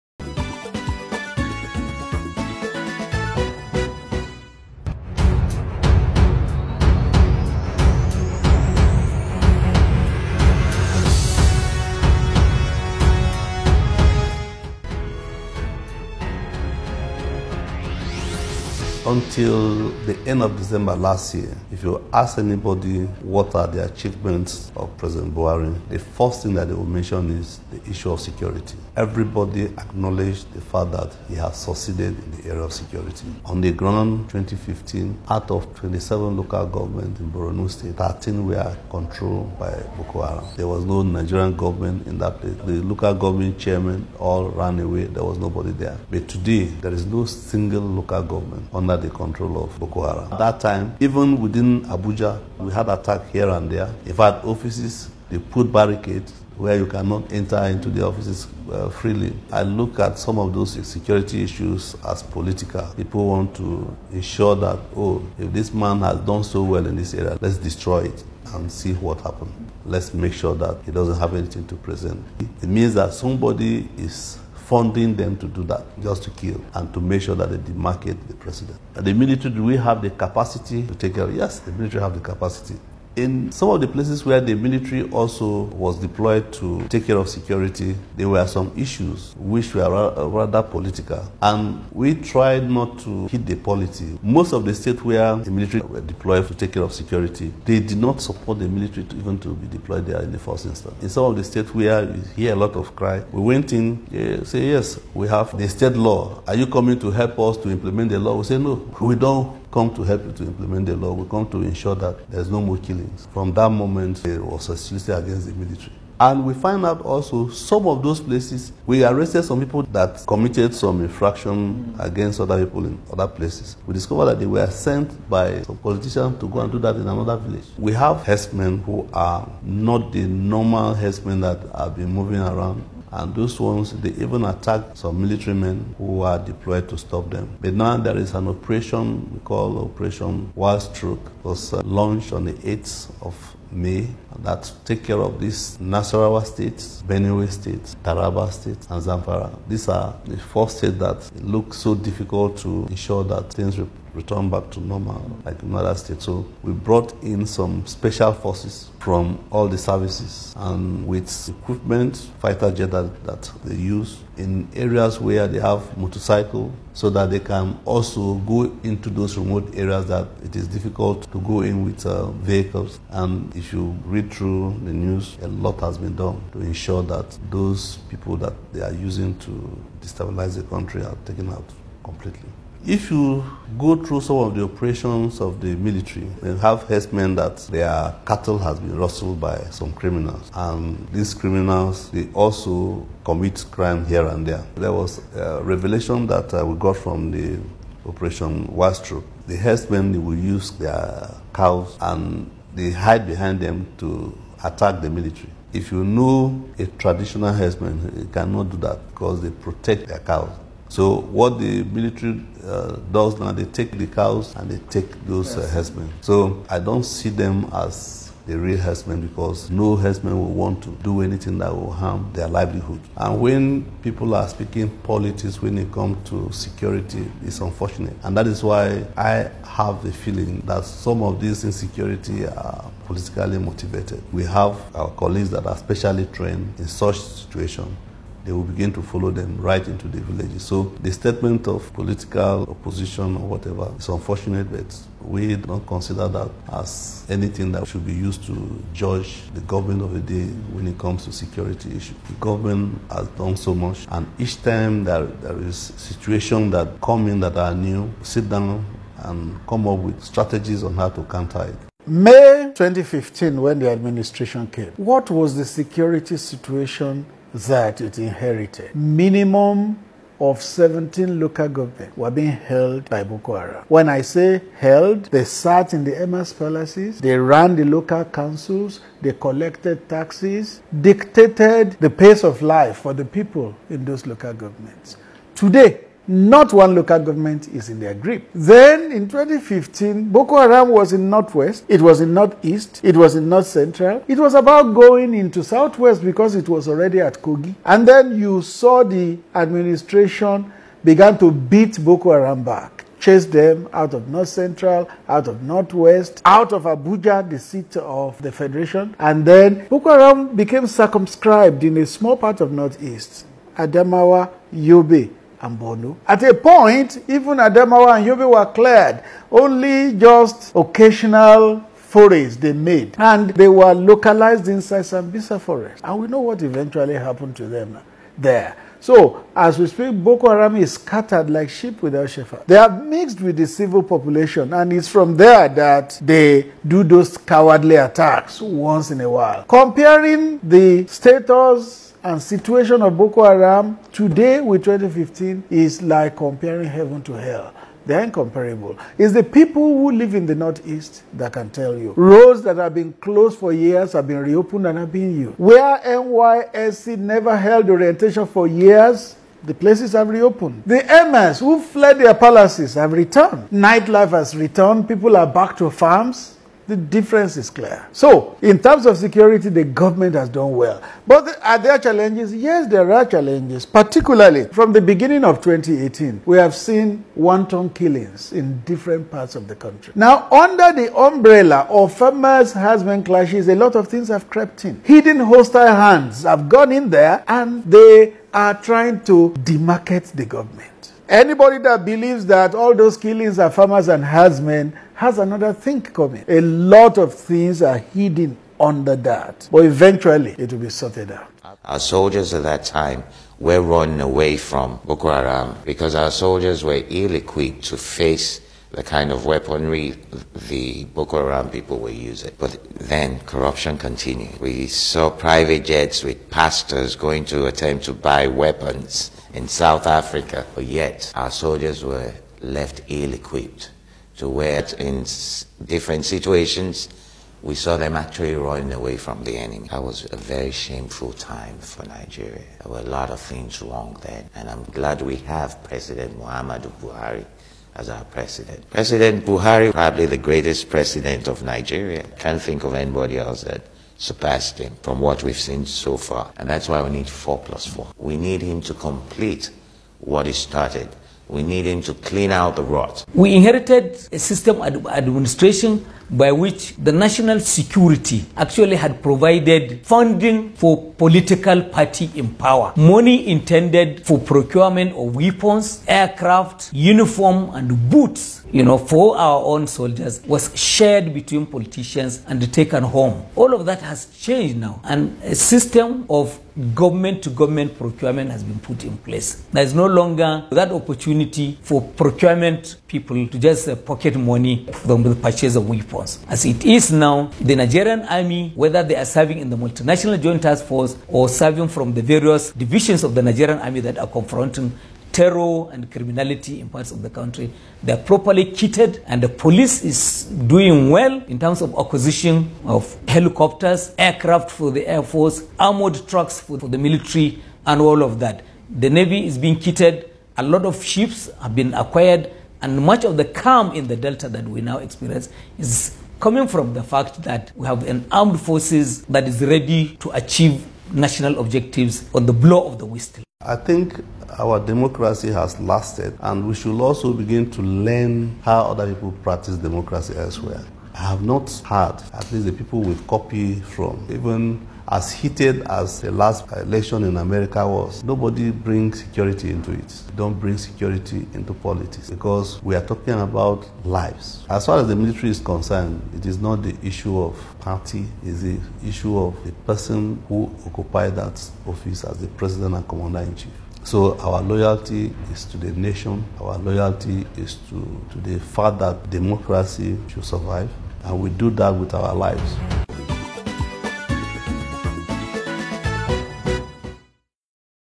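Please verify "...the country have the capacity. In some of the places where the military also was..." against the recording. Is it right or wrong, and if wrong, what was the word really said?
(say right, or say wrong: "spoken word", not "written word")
wrong: "military", not "country".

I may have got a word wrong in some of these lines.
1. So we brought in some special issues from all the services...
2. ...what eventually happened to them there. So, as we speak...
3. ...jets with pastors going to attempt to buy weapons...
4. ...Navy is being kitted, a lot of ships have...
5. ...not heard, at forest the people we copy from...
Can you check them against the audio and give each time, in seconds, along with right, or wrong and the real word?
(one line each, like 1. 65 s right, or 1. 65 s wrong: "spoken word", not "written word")
1. 156 s wrong: "forces", not "issues"
2. 326 s right
3. 415 s right
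4. 509 s right
5. 531 s wrong: "least", not "forest".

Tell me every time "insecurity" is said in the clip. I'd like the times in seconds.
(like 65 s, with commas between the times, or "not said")
231 s.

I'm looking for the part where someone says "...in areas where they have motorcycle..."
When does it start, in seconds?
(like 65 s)
164 s.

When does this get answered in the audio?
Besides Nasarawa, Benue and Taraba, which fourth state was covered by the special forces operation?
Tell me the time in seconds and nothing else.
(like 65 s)
149 s.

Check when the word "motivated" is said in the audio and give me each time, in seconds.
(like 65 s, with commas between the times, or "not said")
233 s.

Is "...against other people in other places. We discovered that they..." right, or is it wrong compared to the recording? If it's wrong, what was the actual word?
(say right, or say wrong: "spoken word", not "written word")
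right.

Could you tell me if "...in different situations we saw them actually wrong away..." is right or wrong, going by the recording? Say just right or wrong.
wrong.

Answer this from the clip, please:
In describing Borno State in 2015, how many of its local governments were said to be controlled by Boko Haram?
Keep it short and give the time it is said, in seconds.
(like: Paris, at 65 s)
13, at 37 s.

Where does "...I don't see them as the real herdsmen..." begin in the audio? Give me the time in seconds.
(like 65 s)
216 s.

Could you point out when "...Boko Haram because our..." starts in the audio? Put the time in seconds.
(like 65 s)
405 s.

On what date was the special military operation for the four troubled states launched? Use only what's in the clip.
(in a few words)
8th of May.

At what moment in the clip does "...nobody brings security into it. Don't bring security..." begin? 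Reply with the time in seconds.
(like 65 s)
538 s.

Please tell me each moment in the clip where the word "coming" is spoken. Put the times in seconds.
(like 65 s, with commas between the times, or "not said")
106 s, 396 s, 516 s.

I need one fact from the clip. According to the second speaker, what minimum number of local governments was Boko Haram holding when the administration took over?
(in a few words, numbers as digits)
17.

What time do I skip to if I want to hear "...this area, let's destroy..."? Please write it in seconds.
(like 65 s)
66 s.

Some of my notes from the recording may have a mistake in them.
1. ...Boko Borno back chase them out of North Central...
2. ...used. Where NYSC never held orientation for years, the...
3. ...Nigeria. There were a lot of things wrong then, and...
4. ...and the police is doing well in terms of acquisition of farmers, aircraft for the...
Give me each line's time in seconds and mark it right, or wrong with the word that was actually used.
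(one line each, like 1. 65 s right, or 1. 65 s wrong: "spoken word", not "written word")
1. 302 s wrong: "Haram", not "Borno"
2. 355 s right
3. 432 s right
4. 499 s wrong: "helicopters", not "farmers".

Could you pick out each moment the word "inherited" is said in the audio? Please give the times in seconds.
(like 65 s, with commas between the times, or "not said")
268 s, 453 s.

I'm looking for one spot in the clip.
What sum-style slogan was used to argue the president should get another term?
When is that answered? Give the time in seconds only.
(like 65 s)
447 s.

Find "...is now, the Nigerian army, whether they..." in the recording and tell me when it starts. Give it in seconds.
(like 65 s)
486 s.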